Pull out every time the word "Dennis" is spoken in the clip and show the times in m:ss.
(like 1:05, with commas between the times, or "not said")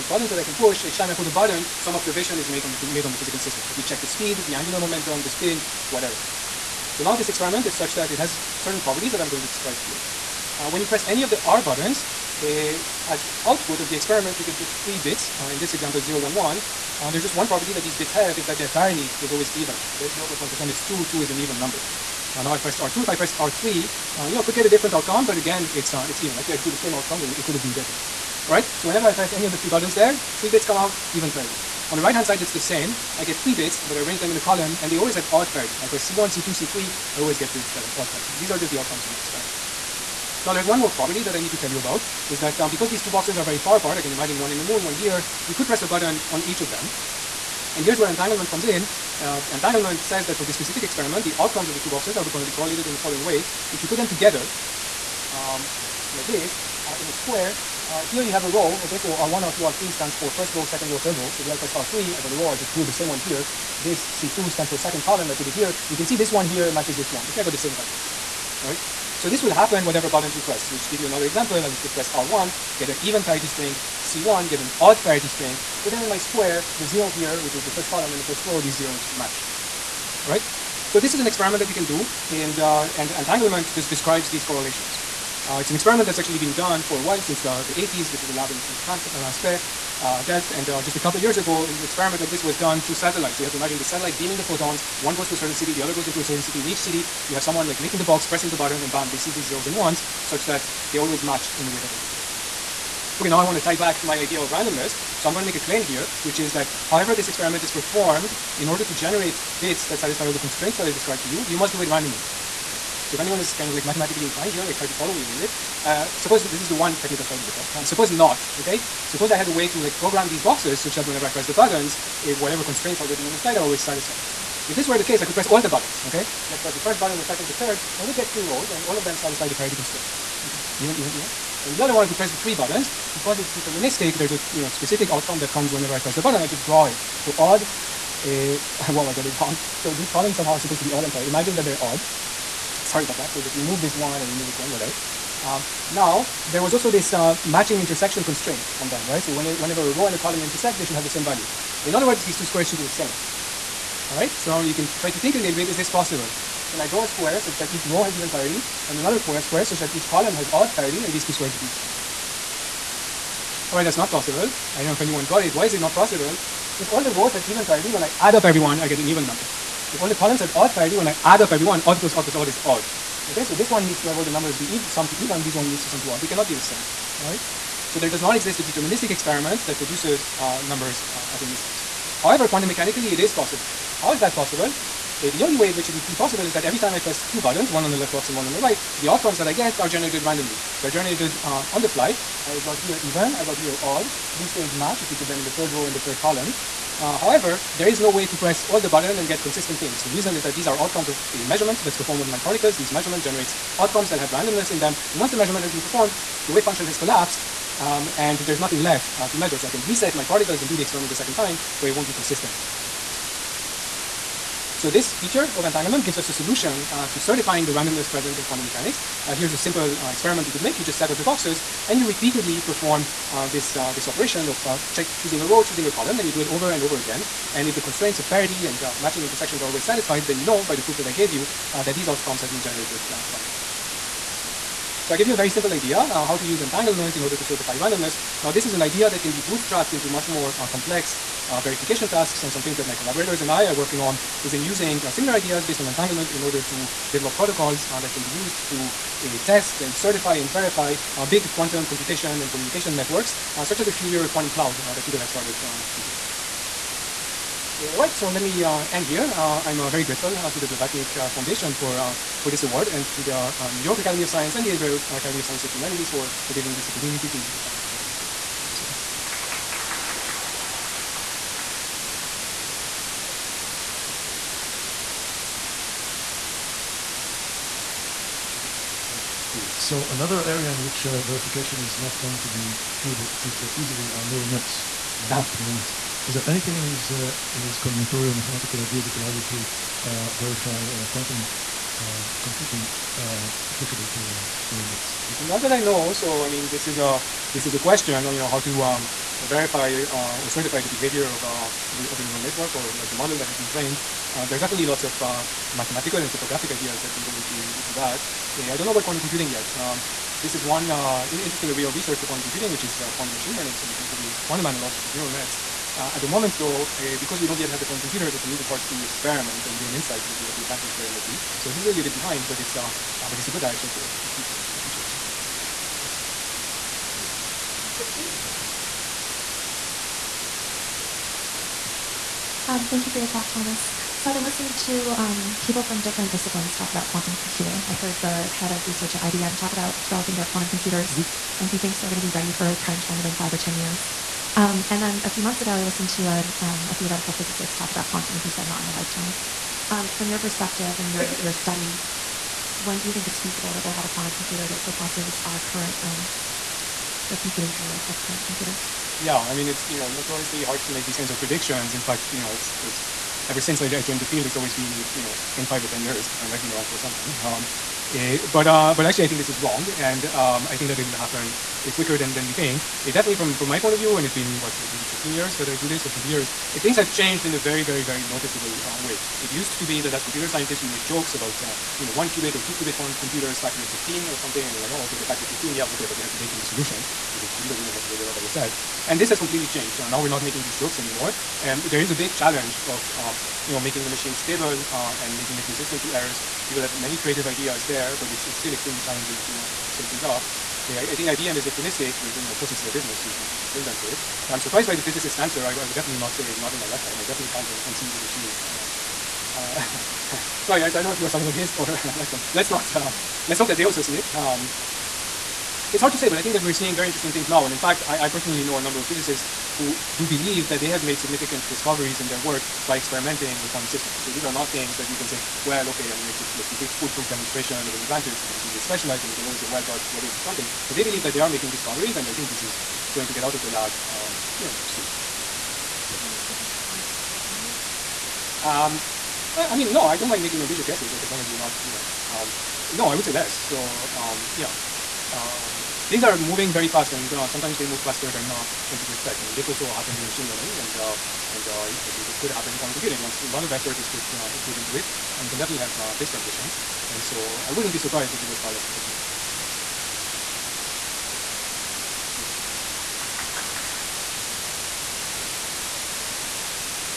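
7:41.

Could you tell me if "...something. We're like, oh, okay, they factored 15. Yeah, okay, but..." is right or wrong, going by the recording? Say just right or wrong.
right.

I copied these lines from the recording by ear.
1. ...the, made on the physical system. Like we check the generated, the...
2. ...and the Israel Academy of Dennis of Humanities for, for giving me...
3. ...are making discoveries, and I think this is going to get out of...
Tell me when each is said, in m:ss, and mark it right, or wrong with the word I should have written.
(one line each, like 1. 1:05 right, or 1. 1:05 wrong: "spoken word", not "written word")
1. 0:02 wrong: "speed", not "generated"
2. 4:24 wrong: "Science", not "Dennis"
3. 7:11 right.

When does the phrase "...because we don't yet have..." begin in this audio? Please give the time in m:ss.
5:17.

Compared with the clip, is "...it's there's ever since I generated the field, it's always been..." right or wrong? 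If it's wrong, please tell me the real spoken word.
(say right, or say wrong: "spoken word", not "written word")
wrong: "joined", not "generated".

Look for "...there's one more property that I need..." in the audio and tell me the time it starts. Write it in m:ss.
0:40.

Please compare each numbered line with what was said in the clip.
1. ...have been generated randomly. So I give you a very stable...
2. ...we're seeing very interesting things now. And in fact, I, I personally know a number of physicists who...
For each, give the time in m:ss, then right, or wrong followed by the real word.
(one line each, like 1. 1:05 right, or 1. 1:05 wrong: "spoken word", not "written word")
1. 3:52 wrong: "simple", not "stable"
2. 6:56 right.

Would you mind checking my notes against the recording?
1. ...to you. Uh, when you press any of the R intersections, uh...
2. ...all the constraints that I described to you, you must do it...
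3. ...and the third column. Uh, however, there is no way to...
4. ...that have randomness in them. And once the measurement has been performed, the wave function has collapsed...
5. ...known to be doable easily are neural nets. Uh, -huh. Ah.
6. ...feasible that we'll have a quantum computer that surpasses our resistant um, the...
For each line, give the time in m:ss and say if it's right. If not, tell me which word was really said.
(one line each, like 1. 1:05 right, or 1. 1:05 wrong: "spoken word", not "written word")
1. 0:09 wrong: "buttons", not "intersections"
2. 1:50 right
3. 3:15 right
4. 3:24 right
5. 4:42 right
6. 5:53 wrong: "current", not "resistant".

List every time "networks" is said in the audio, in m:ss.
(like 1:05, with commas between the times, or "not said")
4:12, 5:02.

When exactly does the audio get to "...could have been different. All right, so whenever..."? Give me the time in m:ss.
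0:27.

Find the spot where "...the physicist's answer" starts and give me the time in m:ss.
6:44.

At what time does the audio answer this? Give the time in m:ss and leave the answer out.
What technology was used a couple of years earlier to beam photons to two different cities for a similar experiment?
1:32.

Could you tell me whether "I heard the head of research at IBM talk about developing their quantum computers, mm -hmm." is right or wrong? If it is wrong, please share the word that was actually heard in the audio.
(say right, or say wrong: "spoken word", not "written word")
right.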